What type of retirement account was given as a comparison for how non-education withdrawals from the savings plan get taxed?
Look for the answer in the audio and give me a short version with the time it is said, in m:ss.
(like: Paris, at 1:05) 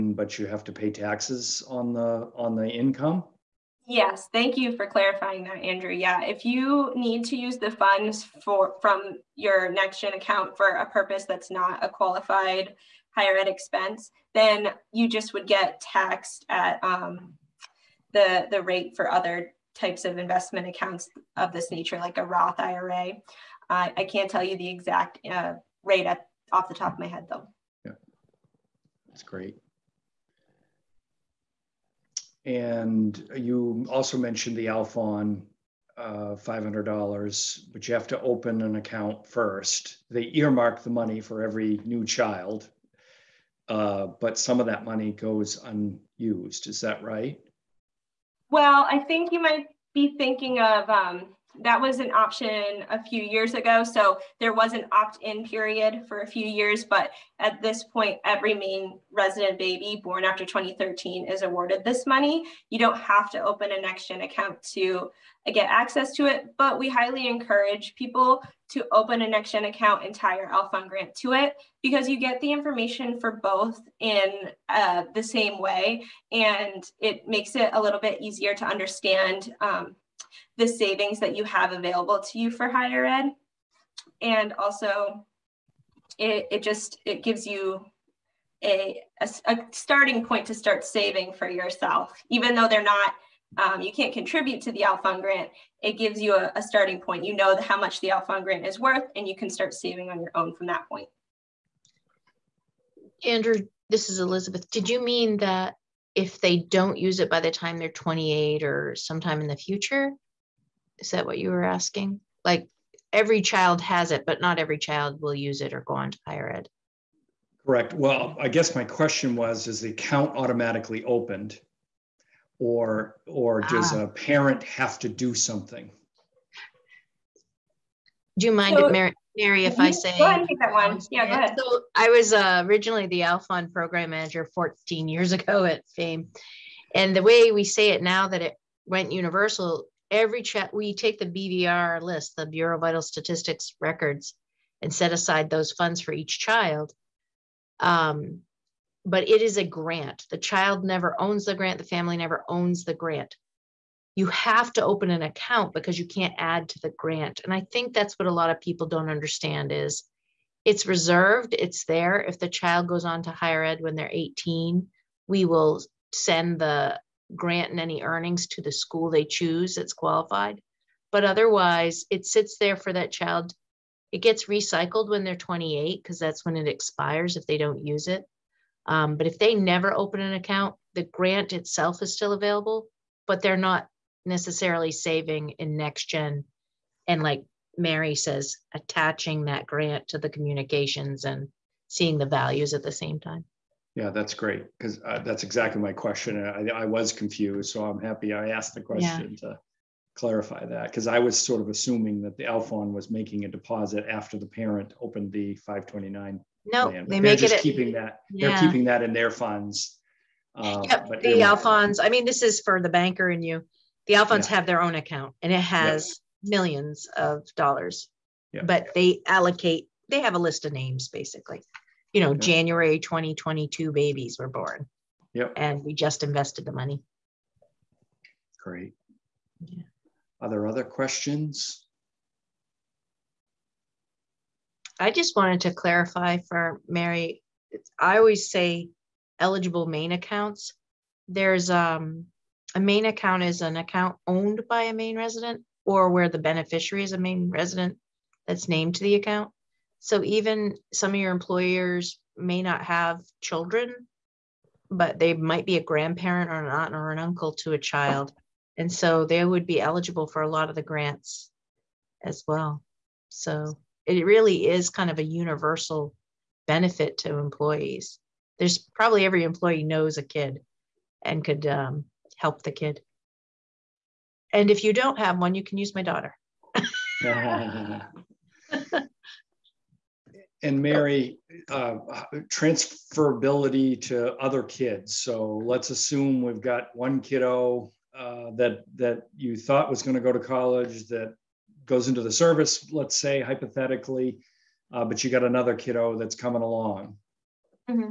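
Roth IRA, at 0:22.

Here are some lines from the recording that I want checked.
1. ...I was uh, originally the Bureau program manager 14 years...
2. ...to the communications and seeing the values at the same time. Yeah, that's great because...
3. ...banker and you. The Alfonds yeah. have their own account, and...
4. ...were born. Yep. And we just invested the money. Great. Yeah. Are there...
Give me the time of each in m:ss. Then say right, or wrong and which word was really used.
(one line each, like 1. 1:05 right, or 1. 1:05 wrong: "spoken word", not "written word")
1. 2:11 wrong: "Alfond", not "Bureau"
2. 3:10 right
3. 3:32 right
4. 3:44 right.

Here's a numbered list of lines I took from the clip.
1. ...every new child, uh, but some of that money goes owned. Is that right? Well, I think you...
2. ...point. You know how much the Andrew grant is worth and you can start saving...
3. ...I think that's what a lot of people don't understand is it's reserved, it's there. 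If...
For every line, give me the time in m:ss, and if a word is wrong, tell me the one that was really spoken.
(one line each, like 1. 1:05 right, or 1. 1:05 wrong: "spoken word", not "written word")
1. 0:41 wrong: "unused", not "owned"
2. 1:37 wrong: "Alfond", not "Andrew"
3. 2:37 right.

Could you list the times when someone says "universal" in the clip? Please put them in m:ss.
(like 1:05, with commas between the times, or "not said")
2:19, 4:25.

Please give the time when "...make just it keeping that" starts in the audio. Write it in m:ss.
3:27.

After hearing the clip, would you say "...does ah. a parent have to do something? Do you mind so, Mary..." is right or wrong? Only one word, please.
right.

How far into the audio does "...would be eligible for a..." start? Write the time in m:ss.
4:19.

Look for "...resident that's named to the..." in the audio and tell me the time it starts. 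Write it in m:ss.
4:07.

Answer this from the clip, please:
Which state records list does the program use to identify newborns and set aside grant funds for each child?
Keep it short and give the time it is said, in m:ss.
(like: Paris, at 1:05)
Bureau of Vital Statistics, at 2:22.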